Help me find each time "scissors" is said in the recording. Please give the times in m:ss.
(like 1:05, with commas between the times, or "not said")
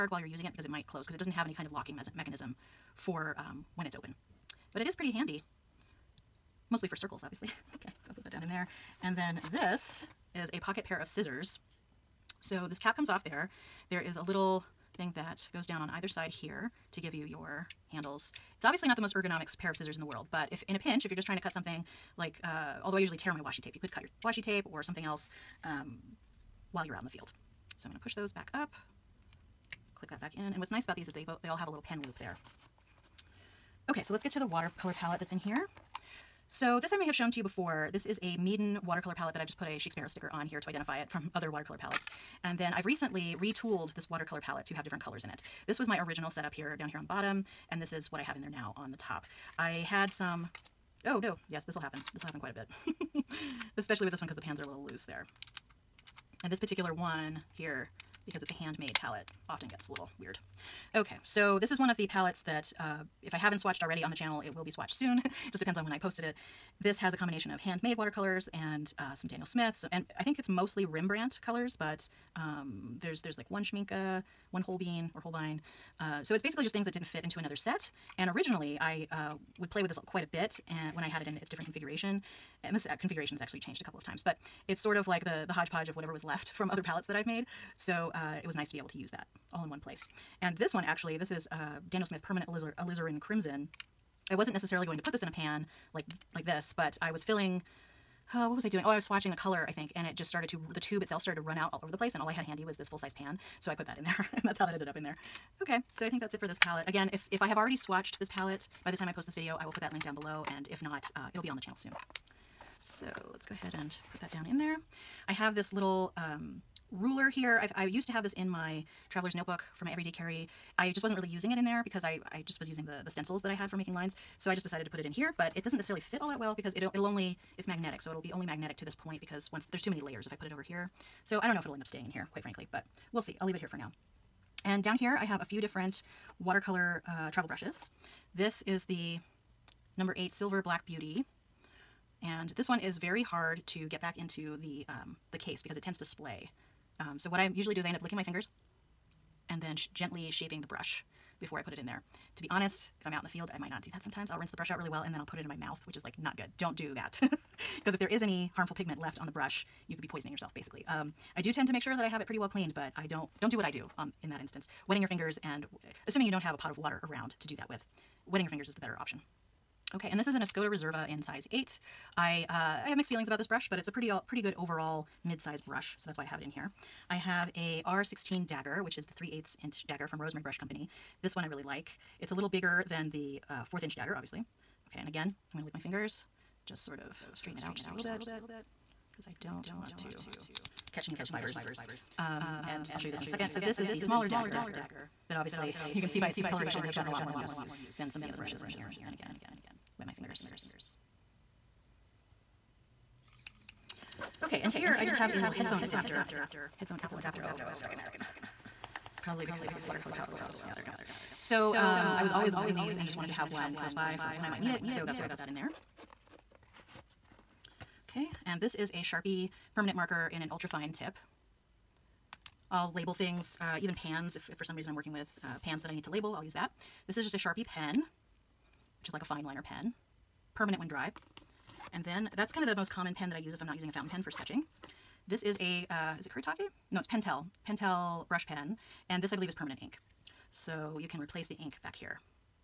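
0:11, 0:19.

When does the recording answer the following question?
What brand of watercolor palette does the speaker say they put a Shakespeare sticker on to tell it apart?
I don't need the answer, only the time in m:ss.
0:38.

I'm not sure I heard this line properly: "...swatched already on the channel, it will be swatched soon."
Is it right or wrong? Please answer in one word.
right.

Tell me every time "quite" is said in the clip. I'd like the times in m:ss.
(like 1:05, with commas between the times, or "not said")
0:52, 1:20, 2:12.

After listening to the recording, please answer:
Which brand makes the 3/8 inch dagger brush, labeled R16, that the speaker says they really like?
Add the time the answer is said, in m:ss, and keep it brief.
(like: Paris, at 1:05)
Rosemary Brush Company, at 3:00.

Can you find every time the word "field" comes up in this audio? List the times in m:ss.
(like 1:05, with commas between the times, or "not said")
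0:27, 2:33.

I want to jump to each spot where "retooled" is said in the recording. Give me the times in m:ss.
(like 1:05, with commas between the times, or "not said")
0:43.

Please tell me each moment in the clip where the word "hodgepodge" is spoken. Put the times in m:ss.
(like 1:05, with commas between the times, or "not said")
1:25.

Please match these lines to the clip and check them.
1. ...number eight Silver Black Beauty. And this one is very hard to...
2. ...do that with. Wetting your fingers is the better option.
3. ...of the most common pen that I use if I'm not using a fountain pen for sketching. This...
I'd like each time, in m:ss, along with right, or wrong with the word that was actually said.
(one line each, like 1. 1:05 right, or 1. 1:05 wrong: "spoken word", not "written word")
1. 2:19 right
2. 2:47 right
3. 3:52 right.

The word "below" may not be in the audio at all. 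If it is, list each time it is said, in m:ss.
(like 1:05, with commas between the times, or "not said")
1:50, 3:30.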